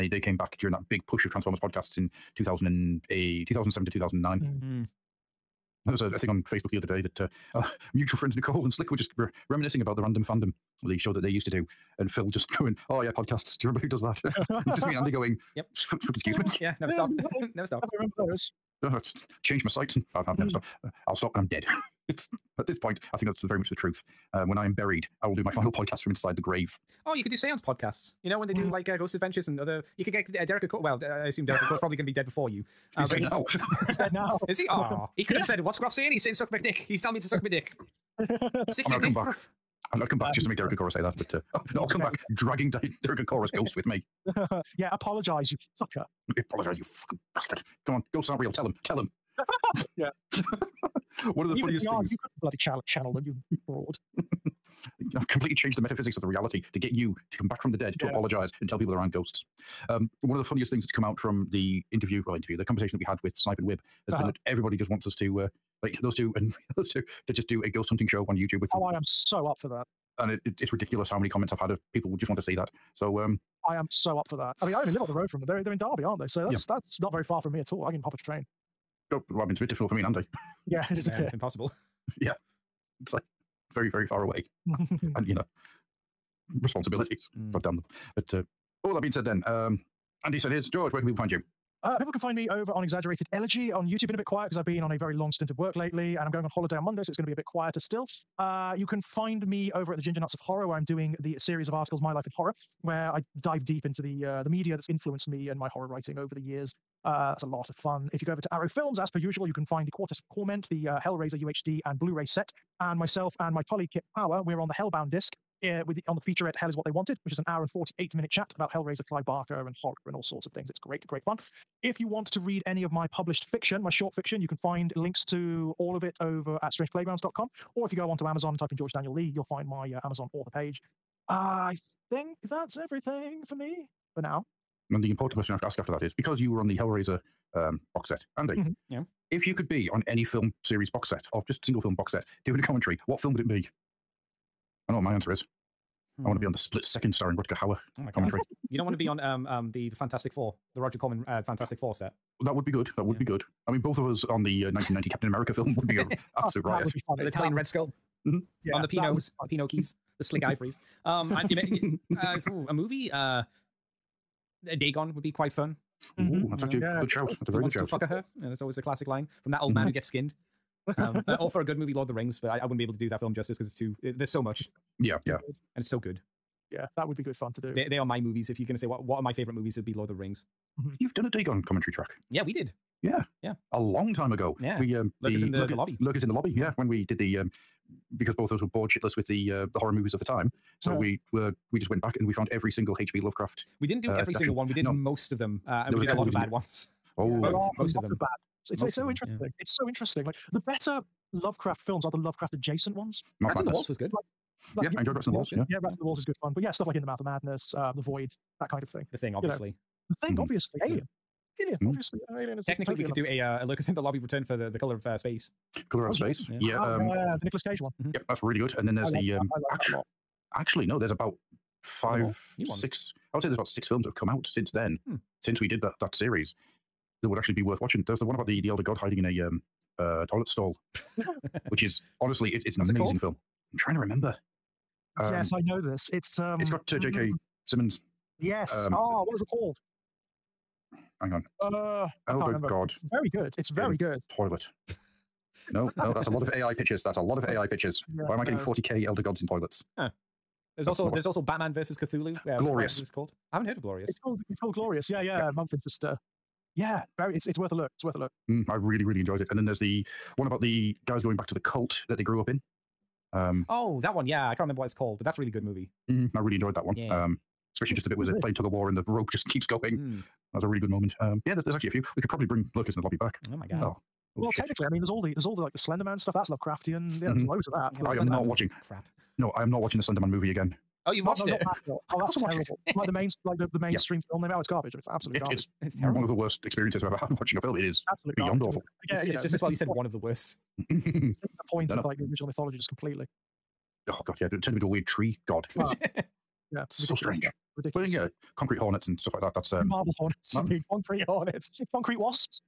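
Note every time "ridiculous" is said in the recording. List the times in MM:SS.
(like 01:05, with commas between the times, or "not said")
01:10, 04:57.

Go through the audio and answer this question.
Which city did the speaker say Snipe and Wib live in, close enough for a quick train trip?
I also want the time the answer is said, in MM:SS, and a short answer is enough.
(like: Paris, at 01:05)
Derby, at 01:15.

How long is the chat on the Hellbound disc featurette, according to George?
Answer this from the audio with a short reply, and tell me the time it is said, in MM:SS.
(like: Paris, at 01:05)
1 hour 48 minutes, at 01:57.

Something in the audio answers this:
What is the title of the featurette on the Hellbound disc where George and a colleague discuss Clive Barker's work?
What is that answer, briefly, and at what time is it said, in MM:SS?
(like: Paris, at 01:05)
Hell is What They Wanted, at 01:56.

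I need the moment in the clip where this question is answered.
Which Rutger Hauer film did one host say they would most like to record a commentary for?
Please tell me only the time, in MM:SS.
02:26.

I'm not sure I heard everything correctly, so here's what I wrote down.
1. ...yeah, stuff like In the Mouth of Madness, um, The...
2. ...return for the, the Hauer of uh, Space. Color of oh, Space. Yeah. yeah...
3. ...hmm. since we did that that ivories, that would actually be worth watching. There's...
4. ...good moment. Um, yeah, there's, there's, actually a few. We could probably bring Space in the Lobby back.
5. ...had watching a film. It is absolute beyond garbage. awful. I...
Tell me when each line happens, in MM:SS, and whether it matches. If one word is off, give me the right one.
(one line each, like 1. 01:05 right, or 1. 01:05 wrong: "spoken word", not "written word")
1. 03:26 right
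2. 03:34 wrong: "Color", not "Hauer"
3. 03:45 wrong: "series", not "ivories"
4. 04:30 wrong: "Lurkers", not "Space"
5. 04:47 right.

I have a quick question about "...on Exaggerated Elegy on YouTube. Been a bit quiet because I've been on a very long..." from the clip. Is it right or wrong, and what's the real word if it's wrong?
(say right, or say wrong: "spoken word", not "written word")
right.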